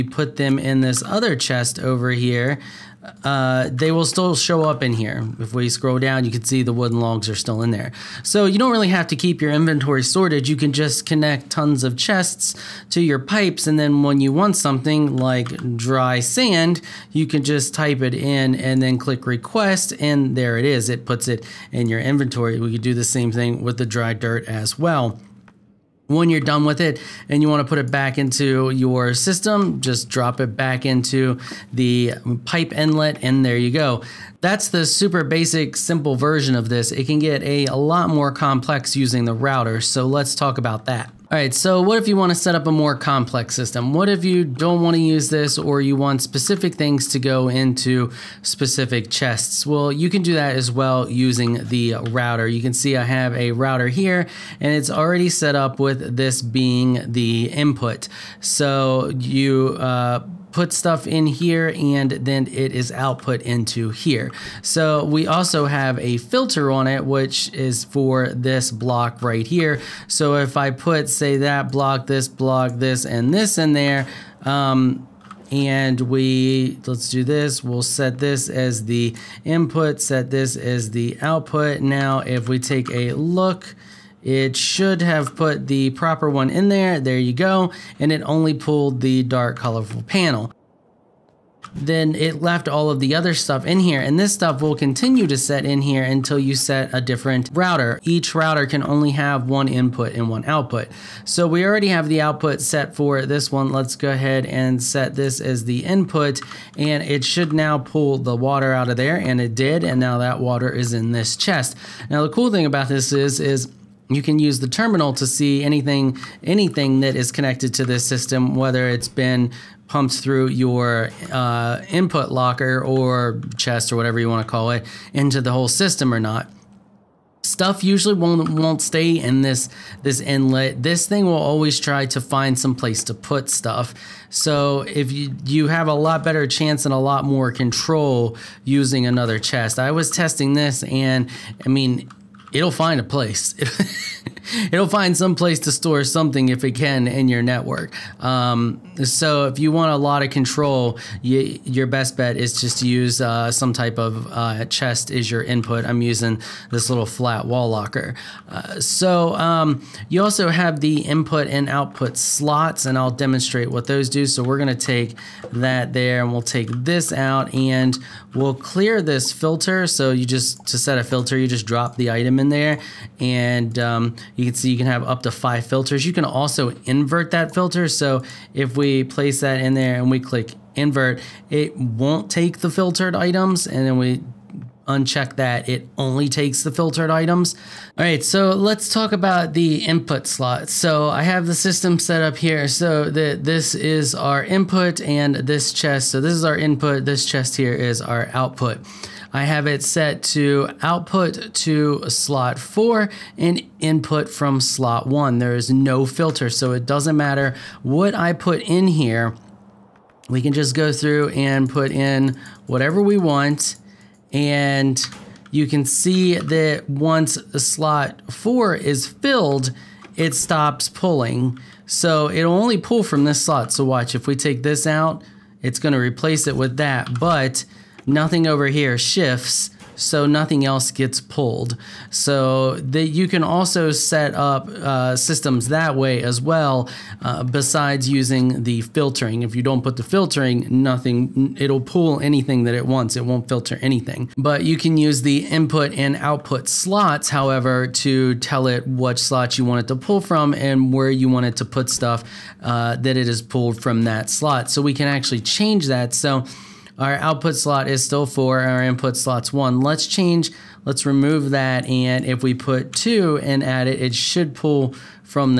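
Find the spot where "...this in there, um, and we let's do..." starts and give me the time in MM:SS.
01:13.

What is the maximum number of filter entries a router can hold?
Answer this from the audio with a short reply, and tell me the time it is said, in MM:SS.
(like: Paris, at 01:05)
5, at 02:55.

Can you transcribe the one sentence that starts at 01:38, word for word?
Each router can only have one input and one output.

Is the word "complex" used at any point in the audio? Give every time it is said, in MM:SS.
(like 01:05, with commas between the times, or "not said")
00:38, 00:42.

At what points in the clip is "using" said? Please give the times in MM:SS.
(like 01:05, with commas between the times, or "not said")
00:38, 00:51, 02:18, 02:36, 03:58.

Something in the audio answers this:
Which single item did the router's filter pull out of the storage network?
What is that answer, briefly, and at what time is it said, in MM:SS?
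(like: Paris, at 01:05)
dark colorful panel, at 01:29.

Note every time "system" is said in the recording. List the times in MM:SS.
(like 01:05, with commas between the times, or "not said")
00:29, 00:43, 01:58, 02:05, 03:11, 03:55.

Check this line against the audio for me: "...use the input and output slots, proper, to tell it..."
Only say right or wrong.
wrong.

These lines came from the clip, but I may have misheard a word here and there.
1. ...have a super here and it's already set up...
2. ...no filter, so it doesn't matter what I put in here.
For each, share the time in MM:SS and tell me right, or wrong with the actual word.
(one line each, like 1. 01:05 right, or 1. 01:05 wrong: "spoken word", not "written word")
1. 00:53 wrong: "router", not "super"
2. 03:25 right.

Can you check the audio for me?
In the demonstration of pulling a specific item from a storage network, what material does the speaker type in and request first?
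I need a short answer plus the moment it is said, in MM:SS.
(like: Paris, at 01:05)
dry sand, at 00:15.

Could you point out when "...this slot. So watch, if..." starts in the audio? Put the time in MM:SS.
03:43.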